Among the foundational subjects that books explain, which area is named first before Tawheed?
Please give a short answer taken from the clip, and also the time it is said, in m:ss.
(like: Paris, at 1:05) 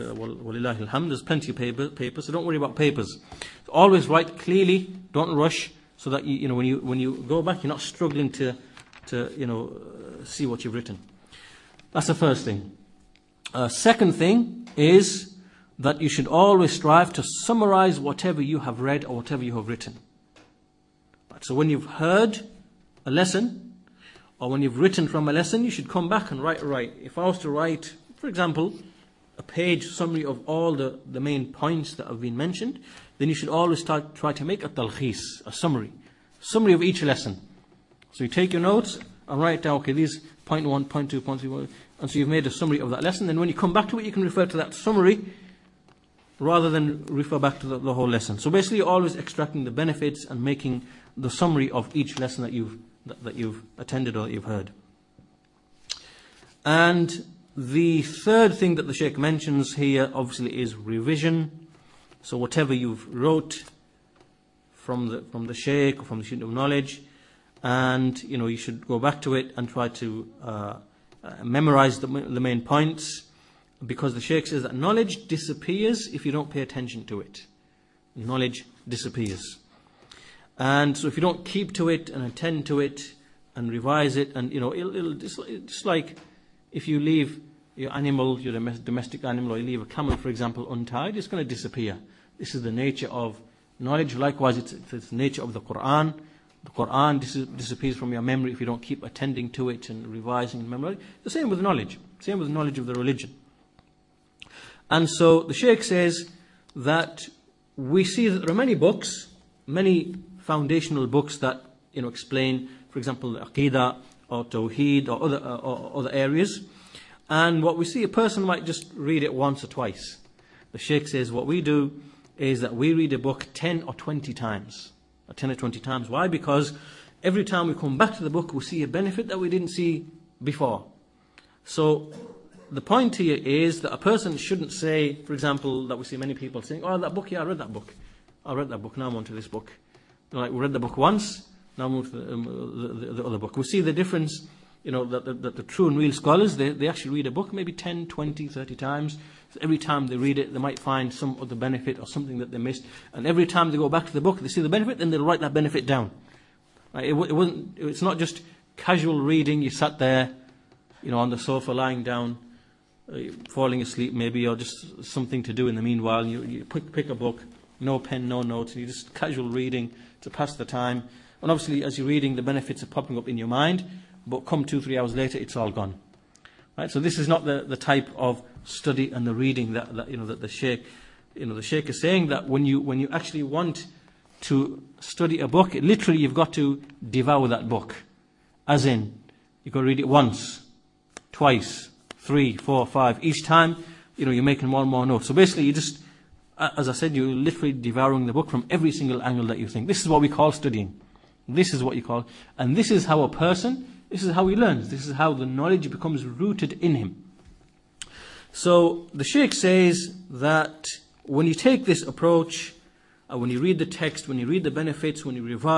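Aqidah, at 1:53.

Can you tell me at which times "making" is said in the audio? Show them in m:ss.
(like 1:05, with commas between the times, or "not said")
0:50, 3:14.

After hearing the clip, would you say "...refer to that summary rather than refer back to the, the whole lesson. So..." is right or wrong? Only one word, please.
right.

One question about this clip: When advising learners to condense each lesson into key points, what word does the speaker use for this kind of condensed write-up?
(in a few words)
talkhis.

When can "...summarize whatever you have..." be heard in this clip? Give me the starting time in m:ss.
0:17.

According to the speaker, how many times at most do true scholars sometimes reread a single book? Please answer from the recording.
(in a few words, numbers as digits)
30.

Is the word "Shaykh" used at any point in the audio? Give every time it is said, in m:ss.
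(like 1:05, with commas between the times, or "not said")
1:05, 1:14.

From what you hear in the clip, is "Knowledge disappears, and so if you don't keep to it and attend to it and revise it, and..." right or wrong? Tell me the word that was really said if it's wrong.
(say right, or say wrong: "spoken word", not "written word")
right.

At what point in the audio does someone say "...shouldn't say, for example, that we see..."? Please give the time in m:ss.
2:14.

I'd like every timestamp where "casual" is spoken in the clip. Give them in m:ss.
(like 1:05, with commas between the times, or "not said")
2:38, 2:49.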